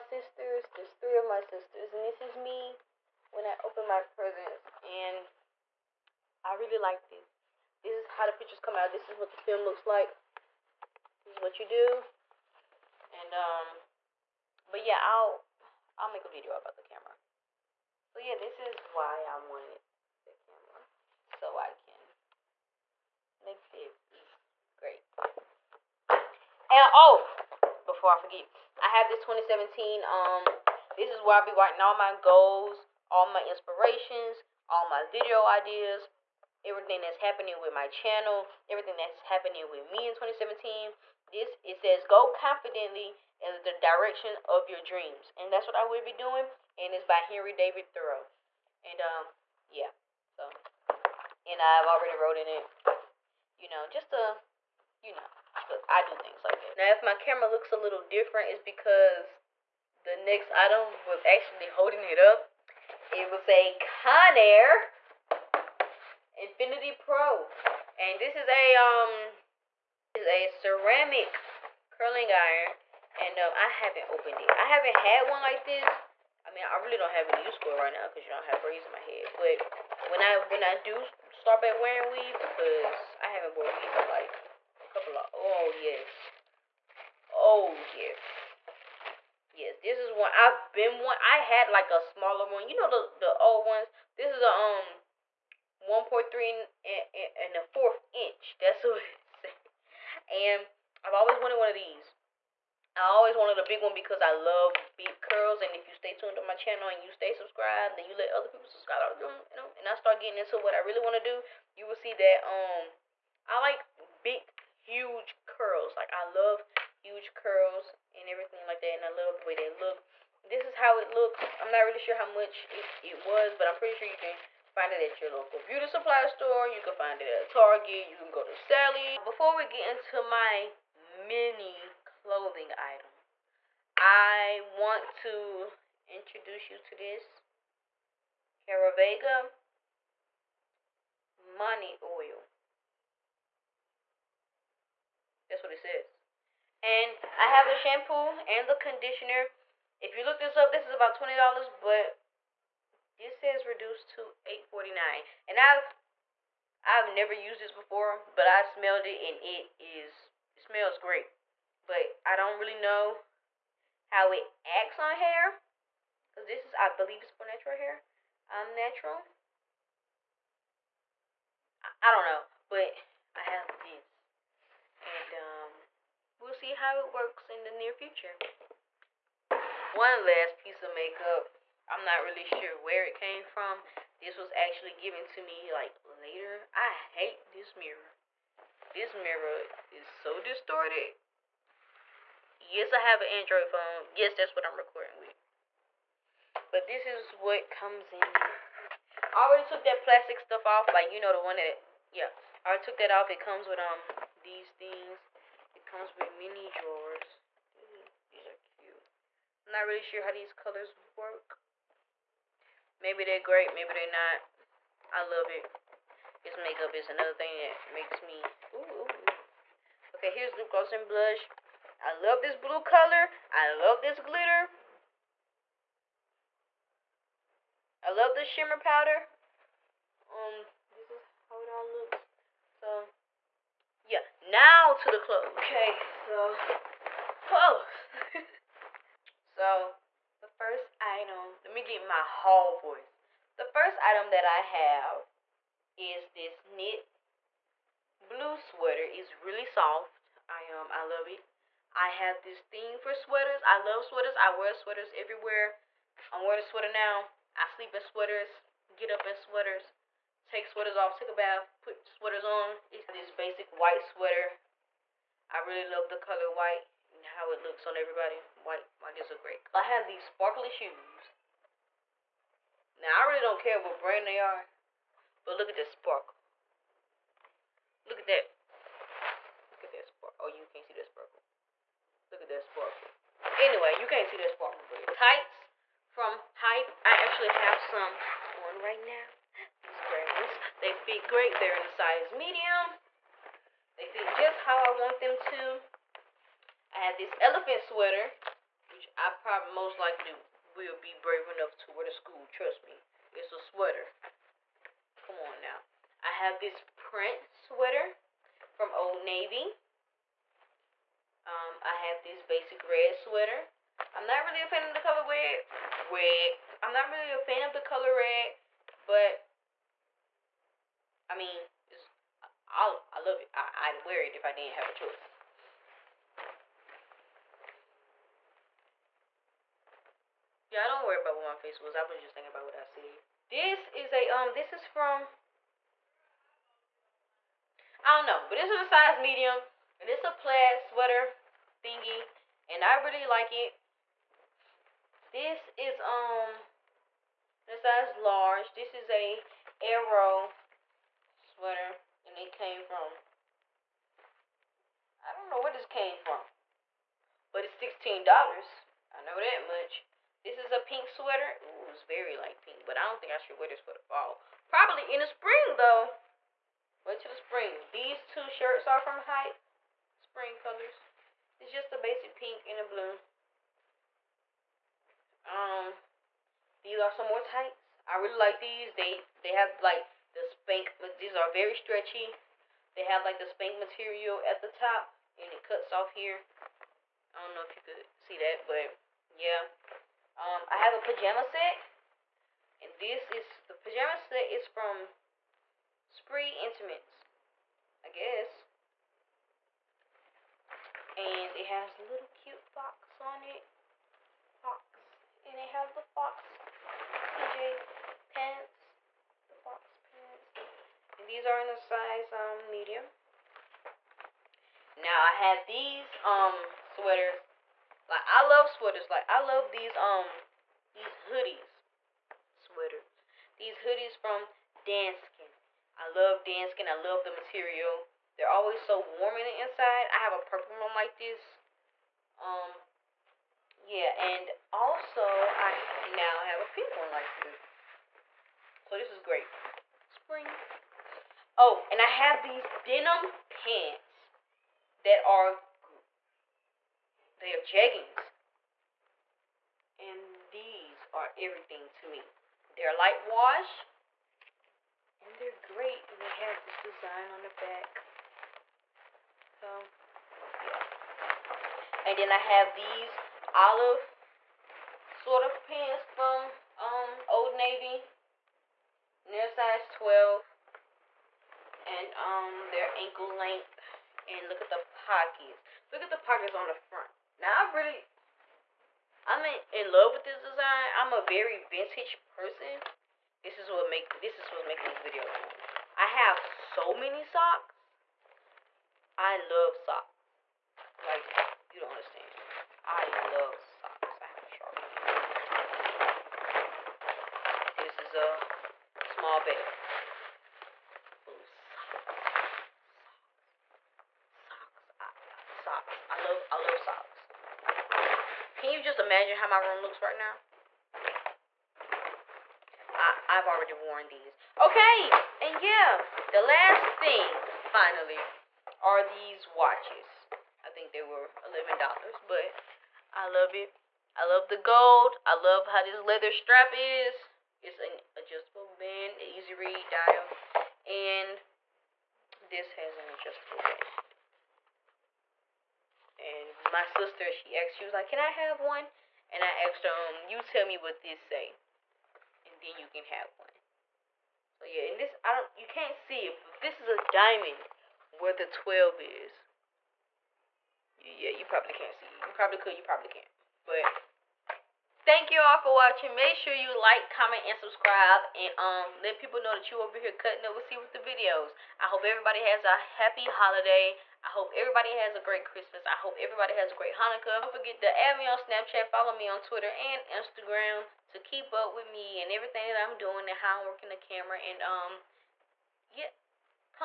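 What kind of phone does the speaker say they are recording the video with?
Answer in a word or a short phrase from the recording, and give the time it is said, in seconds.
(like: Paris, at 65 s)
Android, at 193 s.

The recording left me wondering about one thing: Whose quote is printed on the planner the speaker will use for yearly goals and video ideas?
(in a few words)
Henry David Thoreau.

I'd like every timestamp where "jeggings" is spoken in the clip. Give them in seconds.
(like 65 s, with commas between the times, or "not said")
447 s.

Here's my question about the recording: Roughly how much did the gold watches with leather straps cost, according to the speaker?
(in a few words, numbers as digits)
$11.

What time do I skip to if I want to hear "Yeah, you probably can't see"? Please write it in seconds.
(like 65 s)
550 s.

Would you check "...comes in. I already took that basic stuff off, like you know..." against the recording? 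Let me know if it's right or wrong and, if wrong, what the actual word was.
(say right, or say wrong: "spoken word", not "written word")
wrong: "plastic", not "basic".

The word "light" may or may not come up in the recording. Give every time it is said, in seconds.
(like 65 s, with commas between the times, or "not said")
362 s, 452 s.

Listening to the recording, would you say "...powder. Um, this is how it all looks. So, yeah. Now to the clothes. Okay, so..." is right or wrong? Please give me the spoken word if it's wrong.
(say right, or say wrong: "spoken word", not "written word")
right.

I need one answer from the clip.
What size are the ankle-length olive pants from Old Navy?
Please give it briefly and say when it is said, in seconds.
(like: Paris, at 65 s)
12, at 469 s.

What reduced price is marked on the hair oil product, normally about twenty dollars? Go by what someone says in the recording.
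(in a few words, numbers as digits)
$8.49.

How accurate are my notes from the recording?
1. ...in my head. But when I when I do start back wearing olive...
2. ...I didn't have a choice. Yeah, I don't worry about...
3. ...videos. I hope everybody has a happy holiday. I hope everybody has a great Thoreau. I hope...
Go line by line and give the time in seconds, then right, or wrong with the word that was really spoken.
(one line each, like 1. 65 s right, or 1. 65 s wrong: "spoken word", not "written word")
1. 78 s wrong: "weave", not "olive"
2. 324 s right
3. 560 s wrong: "Christmas", not "Thoreau".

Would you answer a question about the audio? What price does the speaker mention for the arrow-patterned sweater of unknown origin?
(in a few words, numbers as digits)
$16.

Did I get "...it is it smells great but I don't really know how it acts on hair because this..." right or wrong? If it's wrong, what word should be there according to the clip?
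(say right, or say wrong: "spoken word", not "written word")
right.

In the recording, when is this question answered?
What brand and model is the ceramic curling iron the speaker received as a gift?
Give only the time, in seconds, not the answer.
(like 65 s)
63 s.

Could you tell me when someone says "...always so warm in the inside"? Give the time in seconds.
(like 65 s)
428 s.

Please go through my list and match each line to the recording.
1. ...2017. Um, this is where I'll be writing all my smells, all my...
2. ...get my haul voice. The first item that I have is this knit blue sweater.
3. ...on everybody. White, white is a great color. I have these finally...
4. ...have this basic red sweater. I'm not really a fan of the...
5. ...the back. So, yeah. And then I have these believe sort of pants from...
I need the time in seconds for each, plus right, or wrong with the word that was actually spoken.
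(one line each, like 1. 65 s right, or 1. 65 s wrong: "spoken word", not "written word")
1. 29 s wrong: "goals", not "smells"
2. 241 s right
3. 267 s wrong: "sparkly", not "finally"
4. 311 s right
5. 457 s wrong: "olive", not "believe".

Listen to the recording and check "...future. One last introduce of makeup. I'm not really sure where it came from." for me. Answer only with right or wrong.
wrong.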